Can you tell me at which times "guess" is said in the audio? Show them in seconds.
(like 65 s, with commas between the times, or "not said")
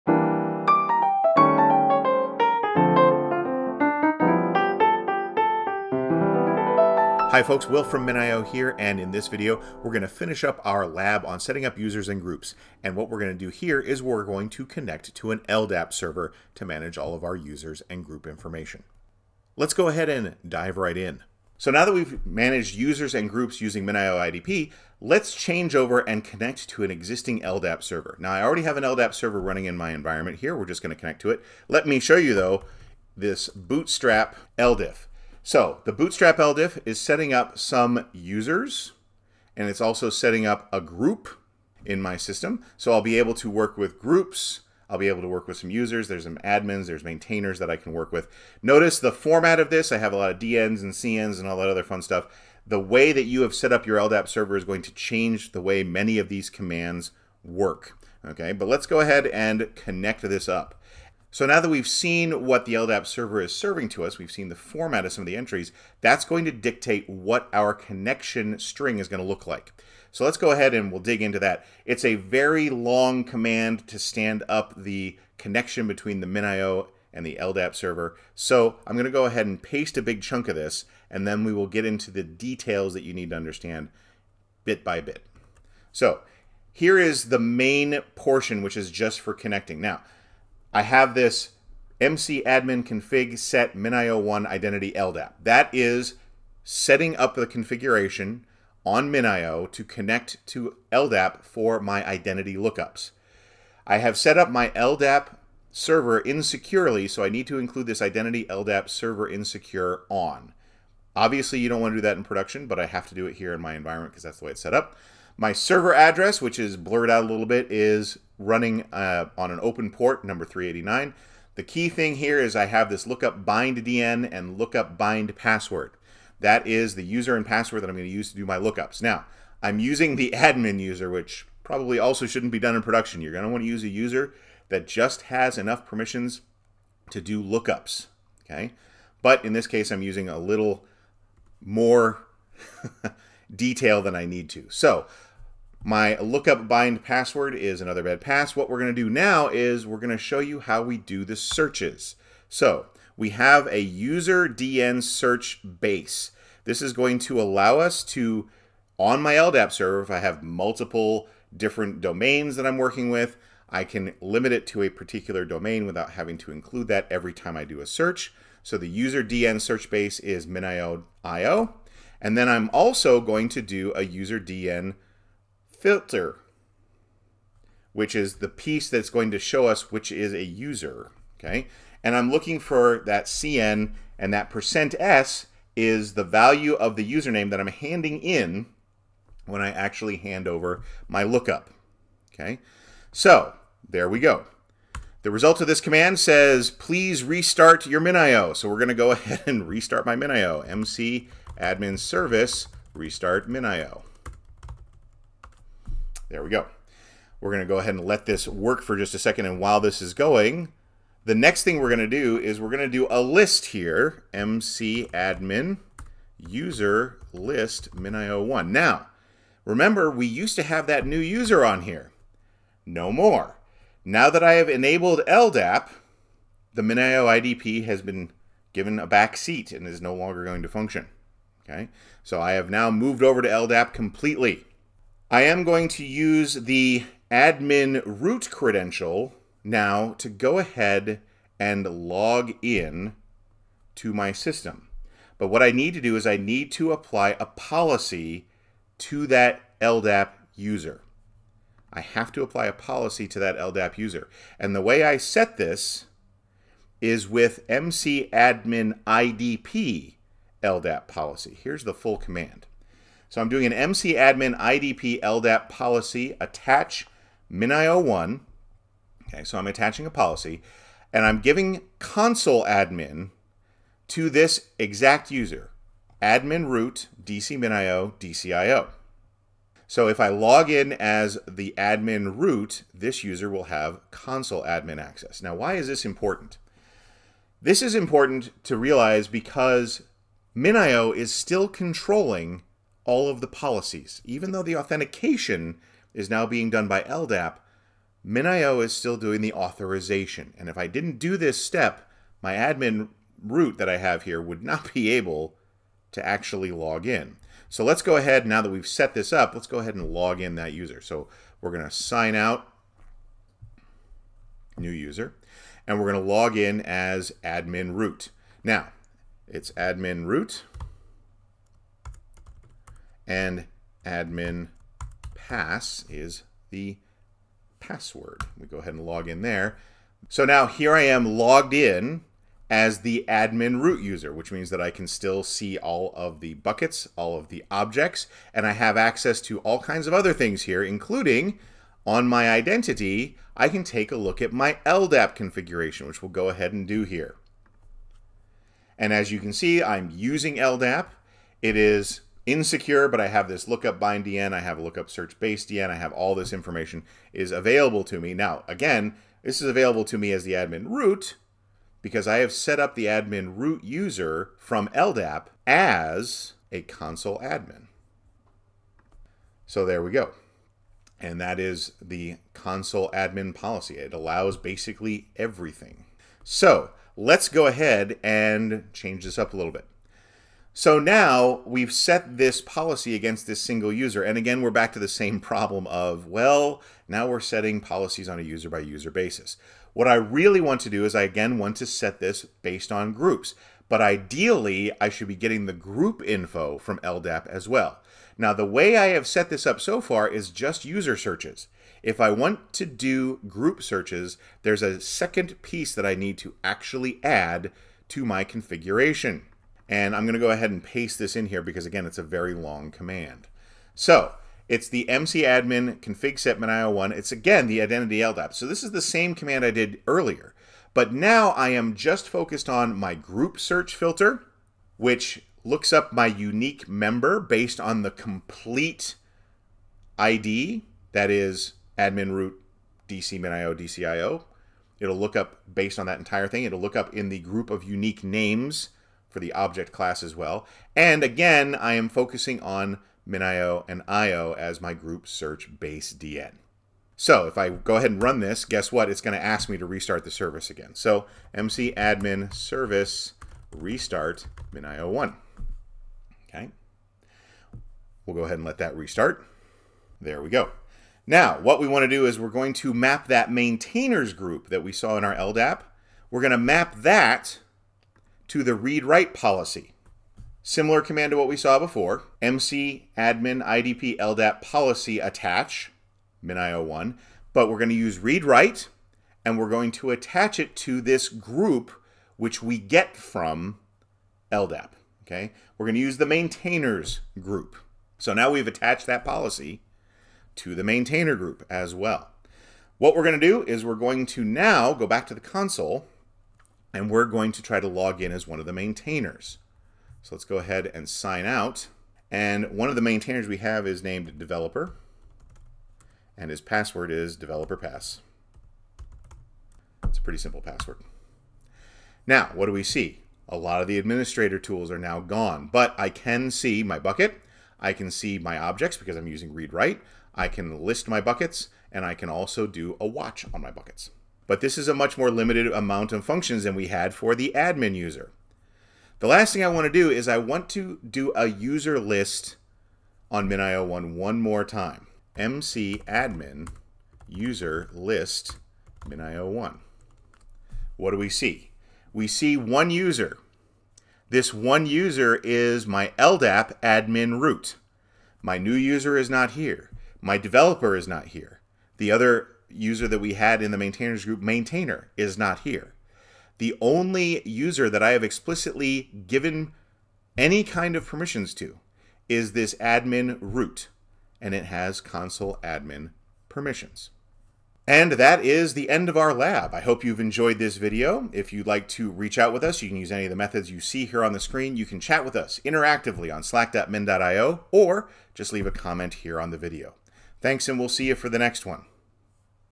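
448 s.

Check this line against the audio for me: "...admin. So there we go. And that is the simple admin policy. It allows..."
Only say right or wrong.
wrong.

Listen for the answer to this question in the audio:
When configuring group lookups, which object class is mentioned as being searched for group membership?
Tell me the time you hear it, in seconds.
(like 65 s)
437 s.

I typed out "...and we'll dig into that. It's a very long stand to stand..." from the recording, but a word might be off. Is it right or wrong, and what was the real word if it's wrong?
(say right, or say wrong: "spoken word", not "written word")
wrong: "command", not "stand".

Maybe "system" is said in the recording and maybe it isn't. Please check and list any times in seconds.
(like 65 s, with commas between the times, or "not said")
42 s, 244 s.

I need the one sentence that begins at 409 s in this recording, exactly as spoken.
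And I'm going to go ahead and paste this in here because, again, it's a very long command.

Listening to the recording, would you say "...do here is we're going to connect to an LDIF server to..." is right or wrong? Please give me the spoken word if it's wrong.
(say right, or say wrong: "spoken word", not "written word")
wrong: "LDAP", not "LDIF".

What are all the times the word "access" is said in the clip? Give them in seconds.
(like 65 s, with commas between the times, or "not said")
285 s, 338 s.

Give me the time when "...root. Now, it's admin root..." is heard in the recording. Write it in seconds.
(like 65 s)
317 s.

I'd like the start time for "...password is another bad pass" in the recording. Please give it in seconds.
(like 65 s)
147 s.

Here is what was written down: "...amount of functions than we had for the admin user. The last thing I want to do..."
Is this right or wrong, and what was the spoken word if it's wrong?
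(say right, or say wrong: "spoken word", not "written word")
right.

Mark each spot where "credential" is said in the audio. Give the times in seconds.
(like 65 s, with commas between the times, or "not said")
238 s.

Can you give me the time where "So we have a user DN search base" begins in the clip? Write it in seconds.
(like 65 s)
152 s.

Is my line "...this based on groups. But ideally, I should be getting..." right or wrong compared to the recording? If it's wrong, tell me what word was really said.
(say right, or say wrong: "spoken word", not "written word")
right.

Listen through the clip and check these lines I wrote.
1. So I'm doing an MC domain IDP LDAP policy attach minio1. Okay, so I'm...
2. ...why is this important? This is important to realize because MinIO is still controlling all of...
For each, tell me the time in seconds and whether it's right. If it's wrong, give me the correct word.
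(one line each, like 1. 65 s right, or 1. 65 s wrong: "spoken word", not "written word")
1. 263 s wrong: "admin", not "domain"
2. 285 s right.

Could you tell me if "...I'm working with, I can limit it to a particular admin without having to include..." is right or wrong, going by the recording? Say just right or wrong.
wrong.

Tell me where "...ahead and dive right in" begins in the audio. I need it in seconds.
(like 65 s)
19 s.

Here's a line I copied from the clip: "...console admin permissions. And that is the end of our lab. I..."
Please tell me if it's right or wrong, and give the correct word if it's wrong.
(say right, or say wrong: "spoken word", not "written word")
right.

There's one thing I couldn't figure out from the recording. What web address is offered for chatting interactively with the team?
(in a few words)
slack.min.io.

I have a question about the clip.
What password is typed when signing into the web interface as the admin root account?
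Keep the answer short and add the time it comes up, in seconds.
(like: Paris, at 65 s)
admin pass, at 324 s.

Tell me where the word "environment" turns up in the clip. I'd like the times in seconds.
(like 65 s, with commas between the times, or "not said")
29 s, 113 s.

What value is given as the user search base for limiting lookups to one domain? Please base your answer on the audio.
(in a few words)
minio.io.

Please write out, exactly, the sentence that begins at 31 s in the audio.
Let me show you though, this bootstrap LDAP.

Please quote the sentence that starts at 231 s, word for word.
Okay, so I have now moved over to LDAP completely.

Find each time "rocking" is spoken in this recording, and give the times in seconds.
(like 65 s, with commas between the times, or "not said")
not said.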